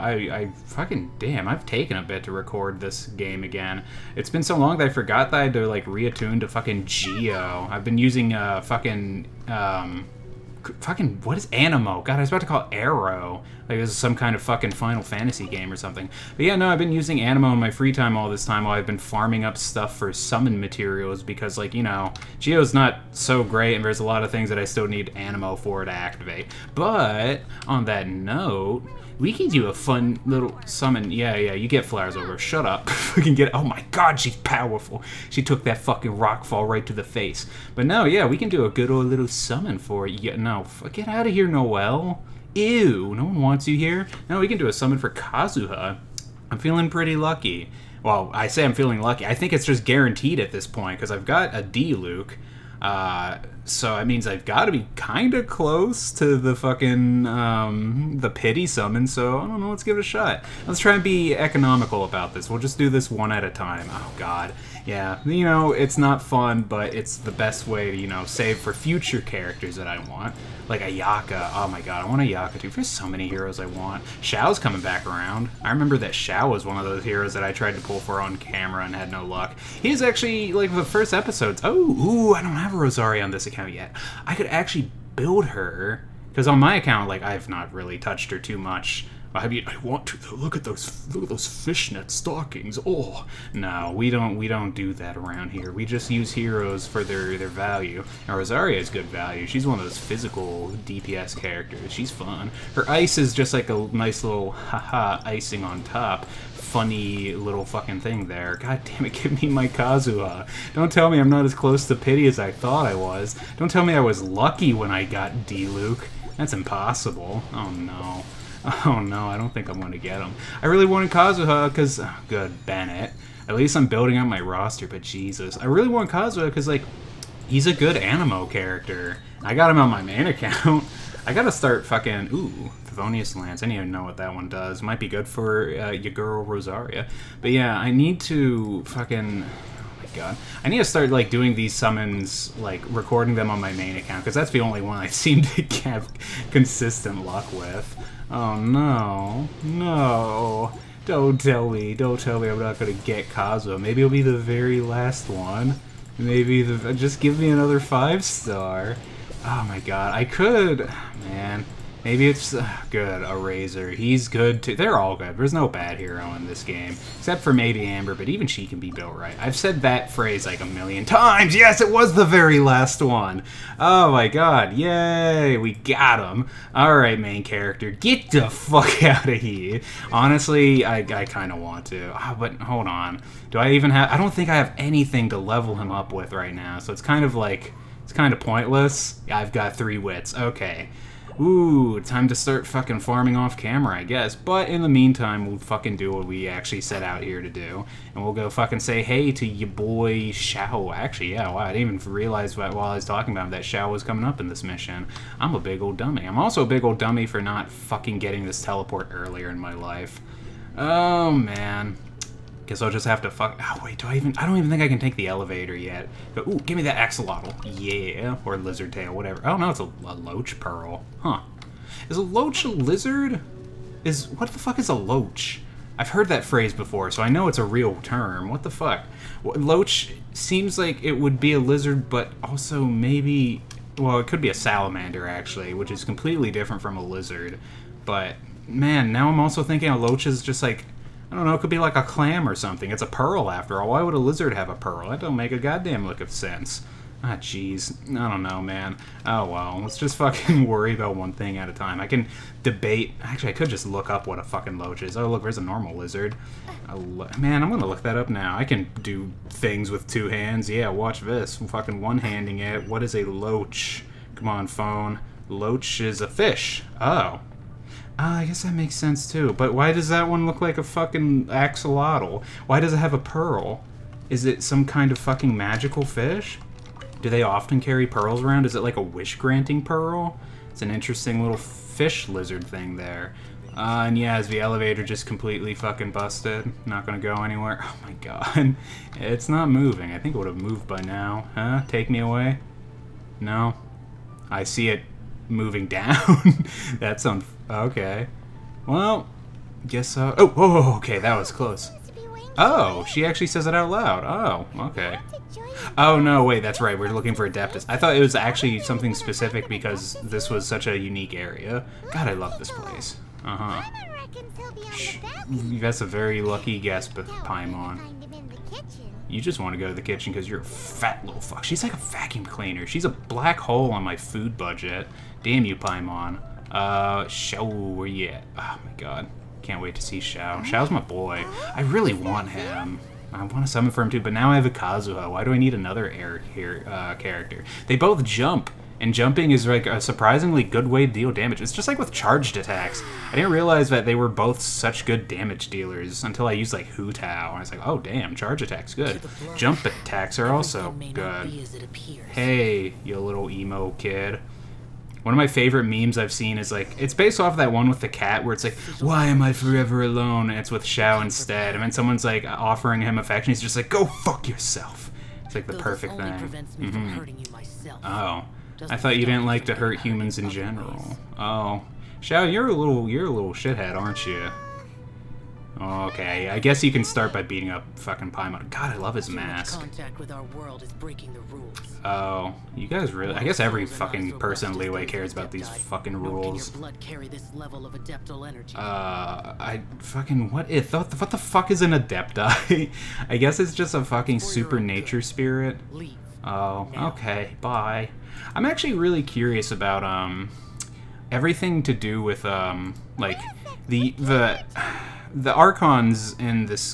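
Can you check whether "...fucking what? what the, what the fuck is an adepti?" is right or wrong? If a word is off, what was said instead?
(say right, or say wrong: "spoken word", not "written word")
right.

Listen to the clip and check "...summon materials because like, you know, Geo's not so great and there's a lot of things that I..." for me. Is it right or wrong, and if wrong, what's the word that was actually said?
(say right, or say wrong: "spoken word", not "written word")
right.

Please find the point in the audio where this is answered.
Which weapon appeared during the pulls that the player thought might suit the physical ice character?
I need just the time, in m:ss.
2:12.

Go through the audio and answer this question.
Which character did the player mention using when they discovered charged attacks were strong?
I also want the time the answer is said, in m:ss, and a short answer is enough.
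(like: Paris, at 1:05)
Hu Tao, at 5:46.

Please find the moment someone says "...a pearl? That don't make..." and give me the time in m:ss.
4:04.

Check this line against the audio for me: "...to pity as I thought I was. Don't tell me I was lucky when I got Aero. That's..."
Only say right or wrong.
wrong.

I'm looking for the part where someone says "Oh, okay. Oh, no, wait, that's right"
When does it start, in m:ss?
5:04.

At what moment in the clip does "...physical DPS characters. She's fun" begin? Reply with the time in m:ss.
1:39.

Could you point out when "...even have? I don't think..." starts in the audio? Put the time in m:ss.
3:03.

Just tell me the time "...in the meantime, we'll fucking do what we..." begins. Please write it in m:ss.
3:14.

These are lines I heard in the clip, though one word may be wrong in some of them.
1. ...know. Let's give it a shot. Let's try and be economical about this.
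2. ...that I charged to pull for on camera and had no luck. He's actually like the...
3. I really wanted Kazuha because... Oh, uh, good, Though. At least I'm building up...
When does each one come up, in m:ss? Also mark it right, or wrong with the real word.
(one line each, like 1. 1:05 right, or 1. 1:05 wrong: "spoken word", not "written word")
1. 0:59 right
2. 1:17 wrong: "tried", not "charged"
3. 2:00 wrong: "Bennett", not "Though".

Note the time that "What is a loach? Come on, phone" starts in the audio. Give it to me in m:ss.
4:22.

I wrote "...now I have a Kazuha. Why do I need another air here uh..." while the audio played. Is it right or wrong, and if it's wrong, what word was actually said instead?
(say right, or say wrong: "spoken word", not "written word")
right.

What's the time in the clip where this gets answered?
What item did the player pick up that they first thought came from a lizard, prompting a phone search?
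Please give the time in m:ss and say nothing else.
3:40.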